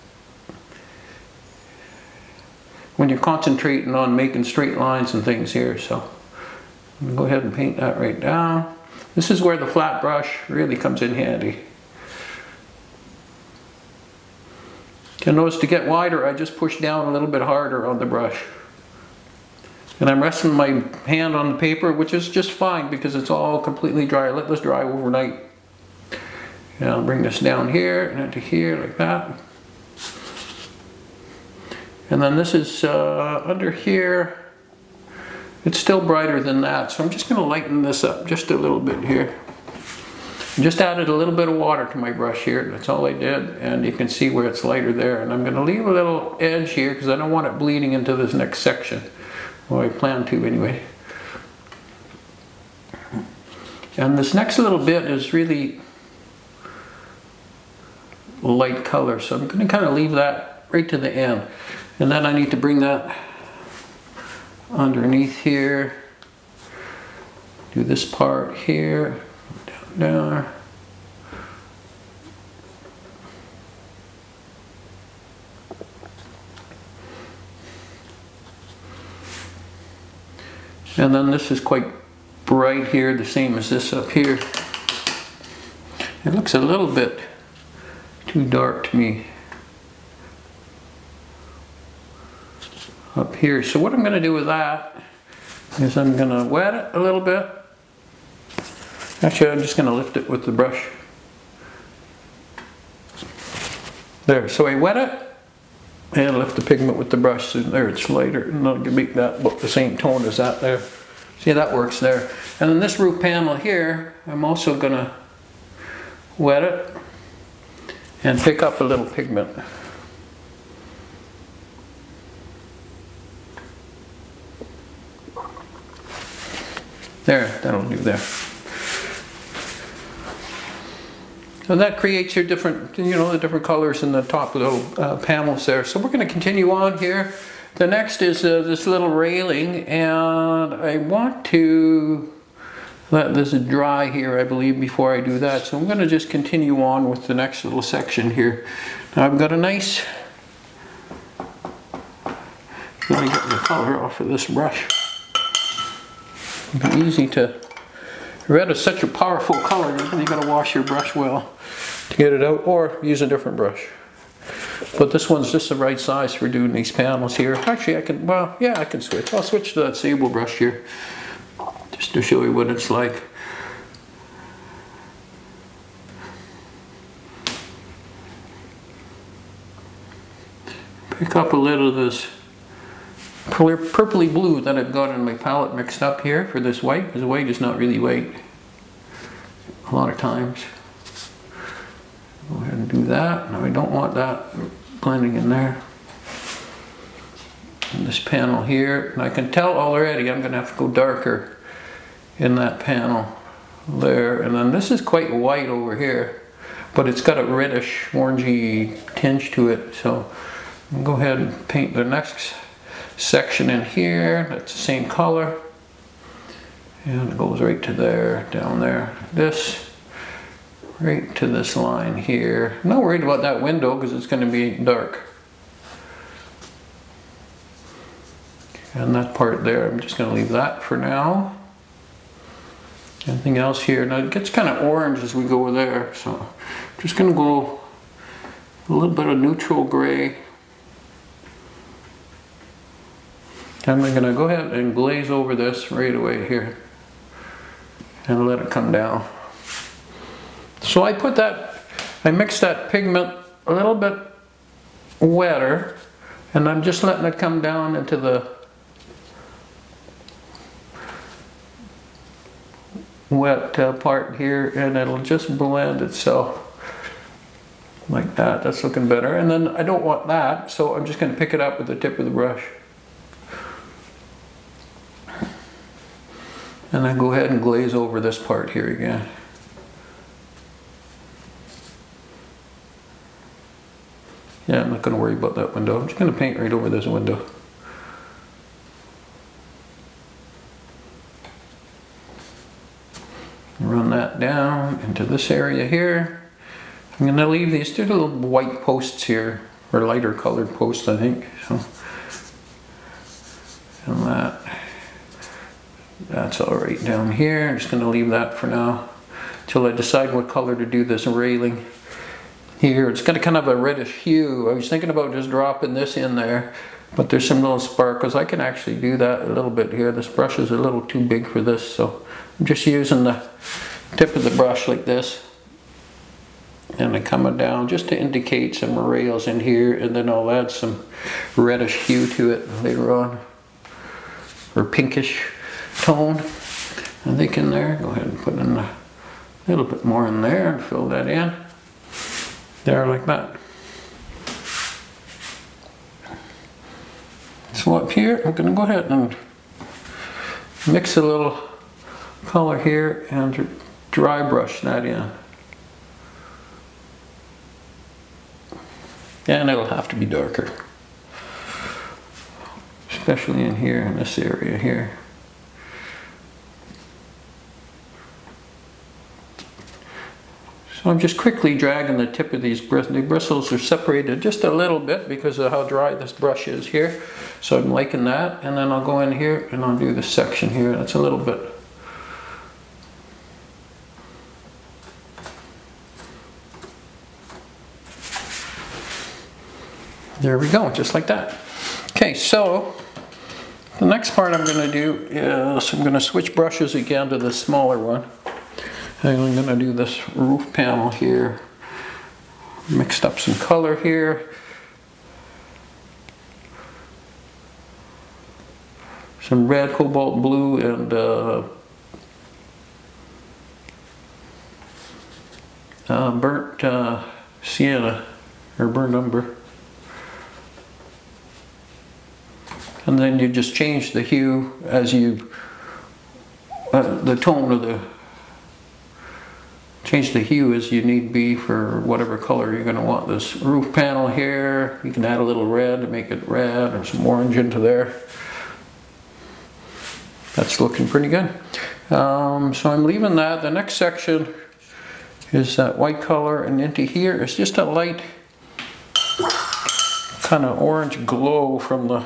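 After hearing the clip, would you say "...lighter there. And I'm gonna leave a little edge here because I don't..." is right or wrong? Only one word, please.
right.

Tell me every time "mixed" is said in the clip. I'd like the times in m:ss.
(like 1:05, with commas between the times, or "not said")
3:05, 4:12, 6:42.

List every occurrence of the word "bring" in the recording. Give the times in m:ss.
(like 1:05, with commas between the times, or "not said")
0:27, 1:02.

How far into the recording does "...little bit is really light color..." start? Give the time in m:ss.
0:54.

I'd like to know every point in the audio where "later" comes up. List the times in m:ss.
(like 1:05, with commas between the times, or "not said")
5:32.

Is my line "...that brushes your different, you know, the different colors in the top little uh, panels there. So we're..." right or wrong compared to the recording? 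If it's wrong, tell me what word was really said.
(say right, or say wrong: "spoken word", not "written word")
wrong: "creates", not "brushes".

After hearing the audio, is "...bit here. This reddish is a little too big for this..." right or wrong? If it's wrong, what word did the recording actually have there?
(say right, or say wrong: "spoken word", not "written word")
wrong: "brush", not "reddish".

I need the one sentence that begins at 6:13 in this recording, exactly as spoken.
The bristles are separated just a little bit because of how dry this brush is here.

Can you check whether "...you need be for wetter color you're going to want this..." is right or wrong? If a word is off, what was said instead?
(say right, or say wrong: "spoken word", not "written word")
wrong: "whatever", not "wetter".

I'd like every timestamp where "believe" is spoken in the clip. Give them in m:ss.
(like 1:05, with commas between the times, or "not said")
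2:24.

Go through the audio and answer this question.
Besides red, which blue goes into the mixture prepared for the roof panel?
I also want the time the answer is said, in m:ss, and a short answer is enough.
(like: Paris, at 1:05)
cobalt blue, at 6:49.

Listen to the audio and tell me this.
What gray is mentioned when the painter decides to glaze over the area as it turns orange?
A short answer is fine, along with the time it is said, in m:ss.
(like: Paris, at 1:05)
neutral gray, at 3:59.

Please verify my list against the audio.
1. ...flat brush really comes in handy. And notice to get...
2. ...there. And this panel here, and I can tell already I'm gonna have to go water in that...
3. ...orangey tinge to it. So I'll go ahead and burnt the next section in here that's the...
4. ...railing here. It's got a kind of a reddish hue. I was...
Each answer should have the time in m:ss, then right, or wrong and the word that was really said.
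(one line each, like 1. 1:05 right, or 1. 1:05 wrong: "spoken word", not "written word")
1. 0:09 right
2. 3:15 wrong: "darker", not "water"
3. 3:28 wrong: "paint", not "burnt"
4. 5:11 right.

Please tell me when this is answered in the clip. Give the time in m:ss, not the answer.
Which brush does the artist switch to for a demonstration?
2:49.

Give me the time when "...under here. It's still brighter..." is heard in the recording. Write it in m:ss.
0:33.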